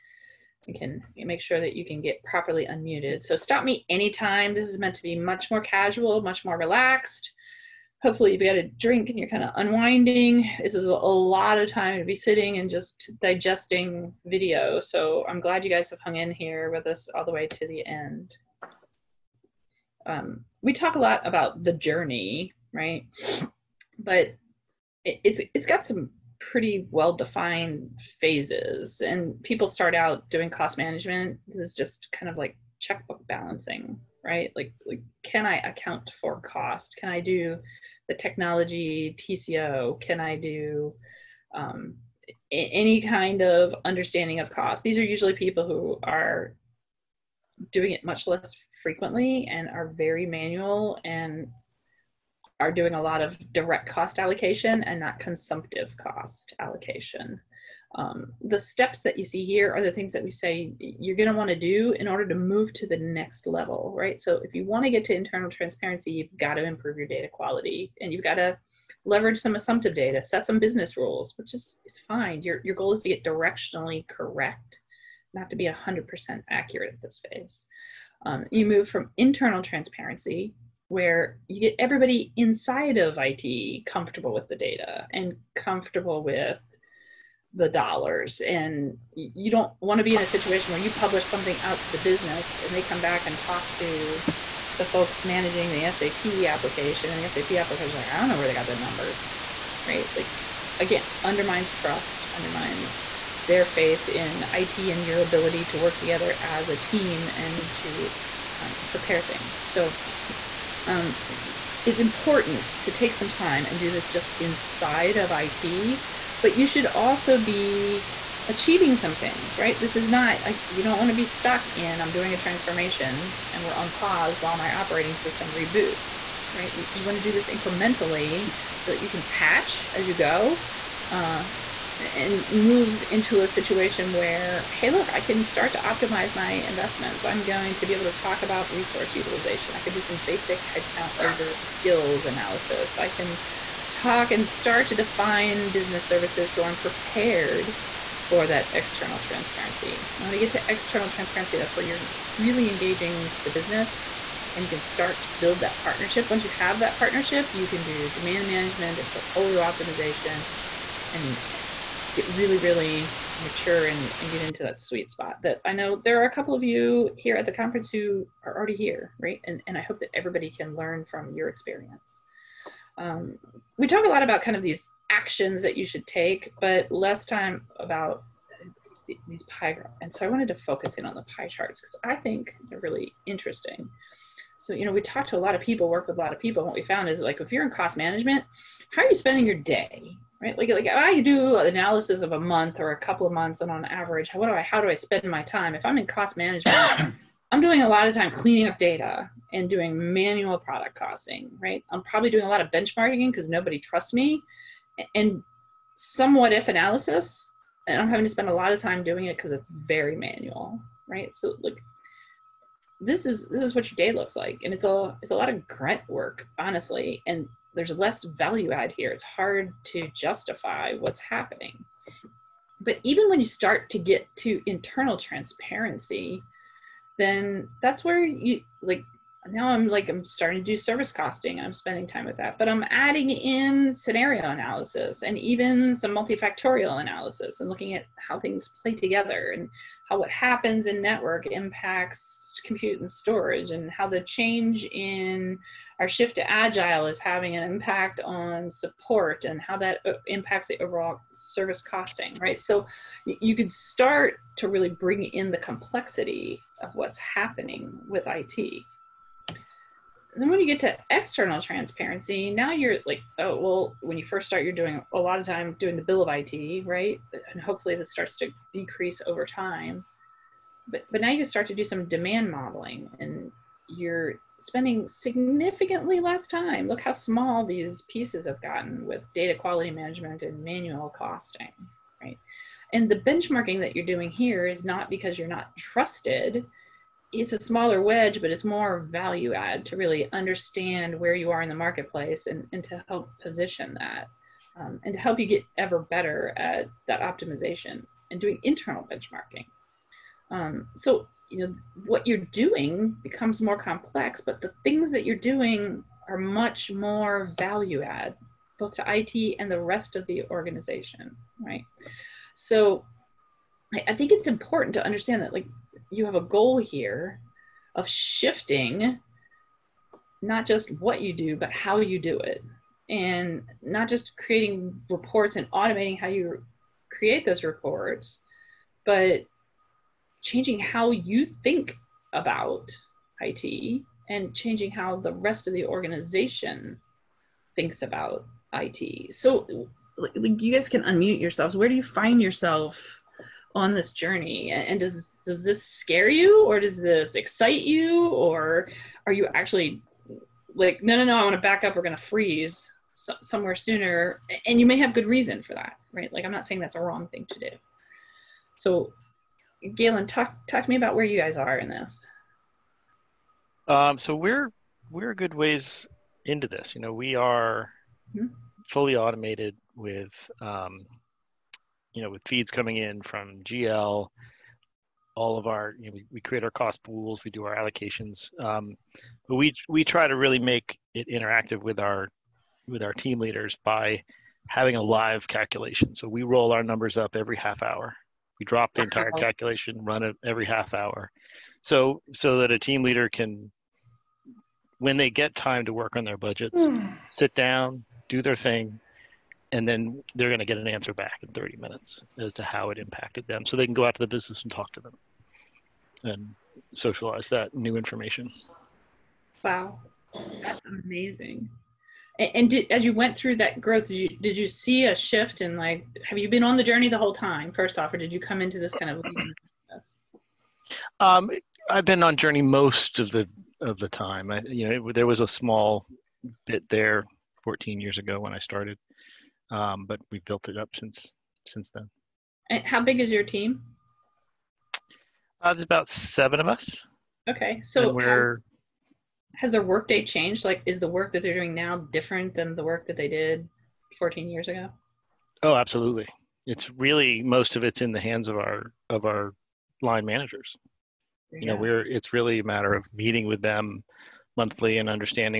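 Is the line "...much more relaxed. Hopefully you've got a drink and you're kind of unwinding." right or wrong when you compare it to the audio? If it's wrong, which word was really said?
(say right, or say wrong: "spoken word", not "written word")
right.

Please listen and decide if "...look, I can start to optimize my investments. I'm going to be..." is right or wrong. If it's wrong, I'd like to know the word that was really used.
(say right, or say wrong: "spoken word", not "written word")
right.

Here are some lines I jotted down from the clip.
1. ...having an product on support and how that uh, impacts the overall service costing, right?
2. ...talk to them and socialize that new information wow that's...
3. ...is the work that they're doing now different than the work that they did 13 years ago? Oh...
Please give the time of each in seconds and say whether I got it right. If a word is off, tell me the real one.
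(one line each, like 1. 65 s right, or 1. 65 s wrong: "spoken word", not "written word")
1. 247 s wrong: "impact", not "product"
2. 404 s right
3. 440 s wrong: "14", not "13".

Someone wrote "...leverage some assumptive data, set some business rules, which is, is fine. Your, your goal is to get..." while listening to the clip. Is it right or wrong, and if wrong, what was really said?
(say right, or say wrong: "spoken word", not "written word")
right.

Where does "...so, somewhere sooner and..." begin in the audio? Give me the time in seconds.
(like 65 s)
353 s.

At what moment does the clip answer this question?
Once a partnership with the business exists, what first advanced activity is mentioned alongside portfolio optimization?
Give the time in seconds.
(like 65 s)
158 s.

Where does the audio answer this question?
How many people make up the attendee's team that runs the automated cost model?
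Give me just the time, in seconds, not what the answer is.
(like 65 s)
436 s.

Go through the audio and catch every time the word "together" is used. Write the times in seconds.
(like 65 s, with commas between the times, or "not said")
105 s, 238 s.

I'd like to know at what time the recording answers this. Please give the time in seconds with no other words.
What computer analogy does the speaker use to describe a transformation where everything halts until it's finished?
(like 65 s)
124 s.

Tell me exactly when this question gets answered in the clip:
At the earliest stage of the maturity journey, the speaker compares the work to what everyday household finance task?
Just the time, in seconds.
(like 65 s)
32 s.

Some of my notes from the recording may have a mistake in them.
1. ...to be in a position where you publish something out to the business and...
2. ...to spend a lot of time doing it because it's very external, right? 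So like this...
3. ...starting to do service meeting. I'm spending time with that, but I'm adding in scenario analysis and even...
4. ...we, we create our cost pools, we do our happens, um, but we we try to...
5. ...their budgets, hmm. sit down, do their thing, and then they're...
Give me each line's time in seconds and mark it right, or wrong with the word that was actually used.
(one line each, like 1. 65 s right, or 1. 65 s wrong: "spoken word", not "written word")
1. 89 s wrong: "situation", not "position"
2. 208 s wrong: "manual", not "external"
3. 230 s wrong: "costing", not "meeting"
4. 376 s wrong: "allocations", not "happens"
5. 396 s right.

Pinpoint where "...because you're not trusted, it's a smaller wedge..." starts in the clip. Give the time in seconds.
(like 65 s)
285 s.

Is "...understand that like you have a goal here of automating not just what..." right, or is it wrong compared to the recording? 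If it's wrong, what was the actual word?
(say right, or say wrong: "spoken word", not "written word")
wrong: "shifting", not "automating".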